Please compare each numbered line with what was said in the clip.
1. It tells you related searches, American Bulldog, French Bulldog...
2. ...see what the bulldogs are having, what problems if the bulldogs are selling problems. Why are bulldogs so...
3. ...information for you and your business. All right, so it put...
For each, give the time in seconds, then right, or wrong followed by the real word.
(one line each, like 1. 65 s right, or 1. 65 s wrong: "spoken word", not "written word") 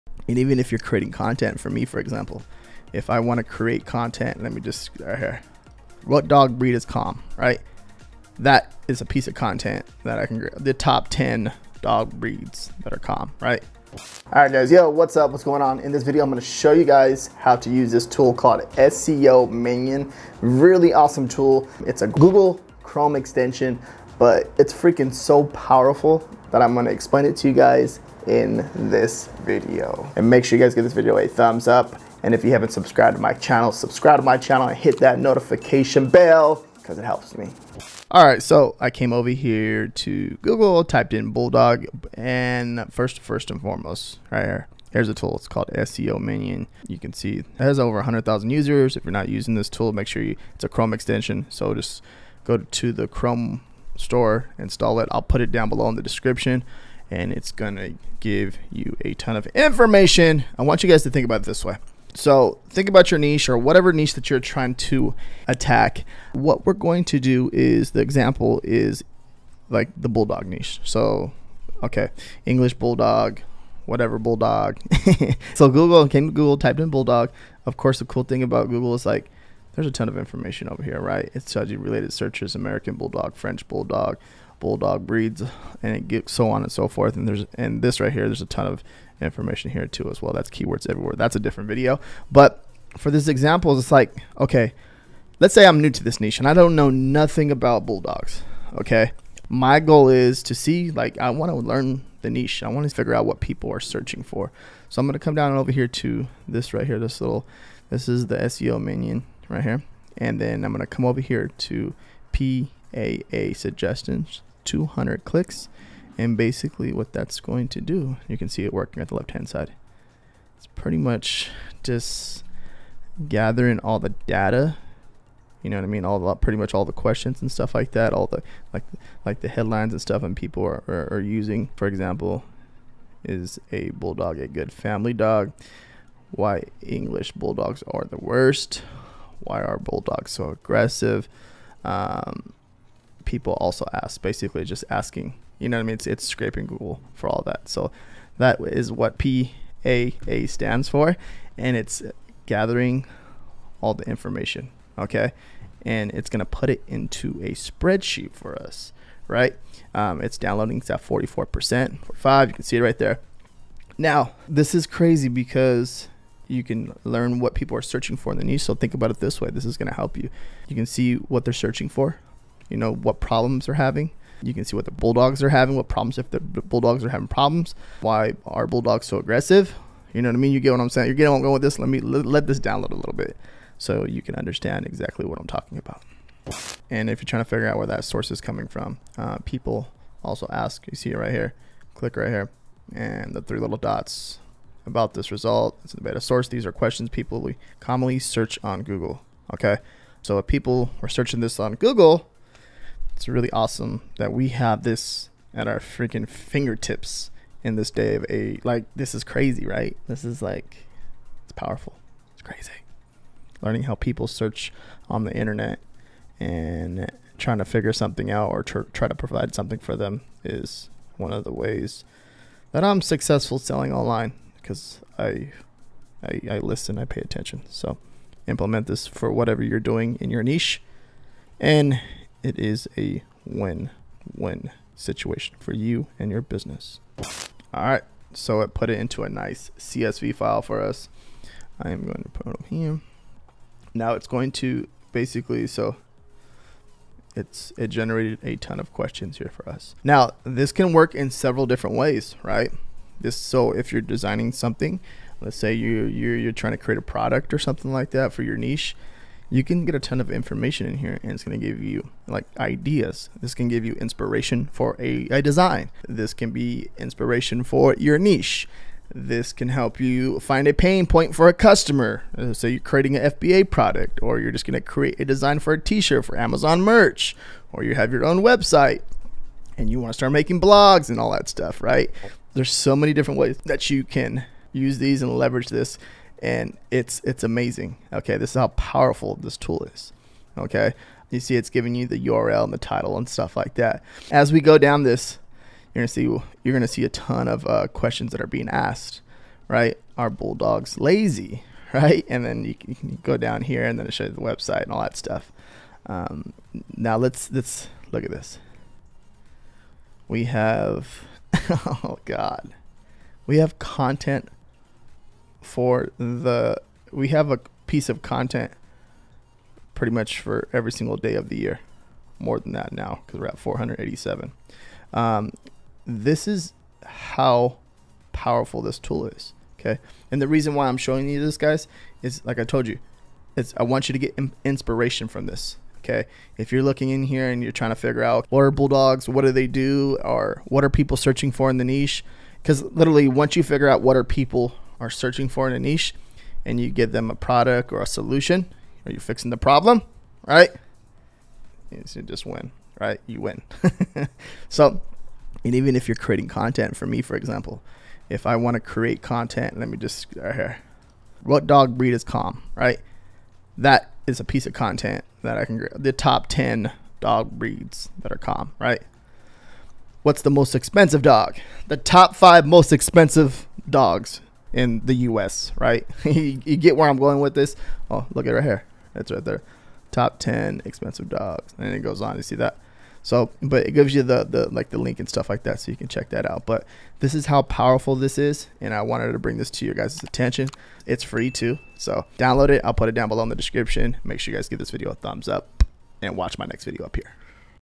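1. 81 s right
2. 174 s wrong: "having", not "selling"
3. 234 s wrong: "situation", not "information".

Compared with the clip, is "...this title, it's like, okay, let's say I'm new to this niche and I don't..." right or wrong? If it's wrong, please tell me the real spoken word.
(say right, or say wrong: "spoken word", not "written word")
wrong: "example", not "title".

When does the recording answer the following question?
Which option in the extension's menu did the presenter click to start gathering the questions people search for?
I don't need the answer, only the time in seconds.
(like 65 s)
112 s.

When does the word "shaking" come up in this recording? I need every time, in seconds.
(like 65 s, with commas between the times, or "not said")
not said.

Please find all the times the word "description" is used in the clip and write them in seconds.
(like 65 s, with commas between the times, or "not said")
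56 s, 393 s.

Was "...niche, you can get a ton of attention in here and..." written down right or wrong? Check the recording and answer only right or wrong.
wrong.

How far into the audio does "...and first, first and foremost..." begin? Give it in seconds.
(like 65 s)
42 s.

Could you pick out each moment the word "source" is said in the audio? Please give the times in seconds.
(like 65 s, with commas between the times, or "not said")
188 s, 196 s.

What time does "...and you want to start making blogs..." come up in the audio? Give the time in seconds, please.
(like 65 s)
279 s.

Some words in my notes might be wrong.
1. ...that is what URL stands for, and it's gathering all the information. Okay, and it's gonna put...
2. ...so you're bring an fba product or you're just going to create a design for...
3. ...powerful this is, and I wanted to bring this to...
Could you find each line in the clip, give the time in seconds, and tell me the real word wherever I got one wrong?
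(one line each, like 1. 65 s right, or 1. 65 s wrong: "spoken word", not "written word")
1. 148 s wrong: "PAA", not "URL"
2. 272 s wrong: "creating", not "bring"
3. 387 s right.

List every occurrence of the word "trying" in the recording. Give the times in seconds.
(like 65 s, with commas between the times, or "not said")
64 s, 187 s, 217 s, 256 s, 337 s.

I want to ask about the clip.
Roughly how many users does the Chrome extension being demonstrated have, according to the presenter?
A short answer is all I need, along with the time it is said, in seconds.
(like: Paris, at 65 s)
over 100,000, at 47 s.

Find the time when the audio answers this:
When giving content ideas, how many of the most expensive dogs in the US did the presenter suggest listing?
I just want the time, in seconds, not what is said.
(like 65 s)
371 s.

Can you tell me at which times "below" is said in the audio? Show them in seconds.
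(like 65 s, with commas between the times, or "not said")
55 s, 393 s.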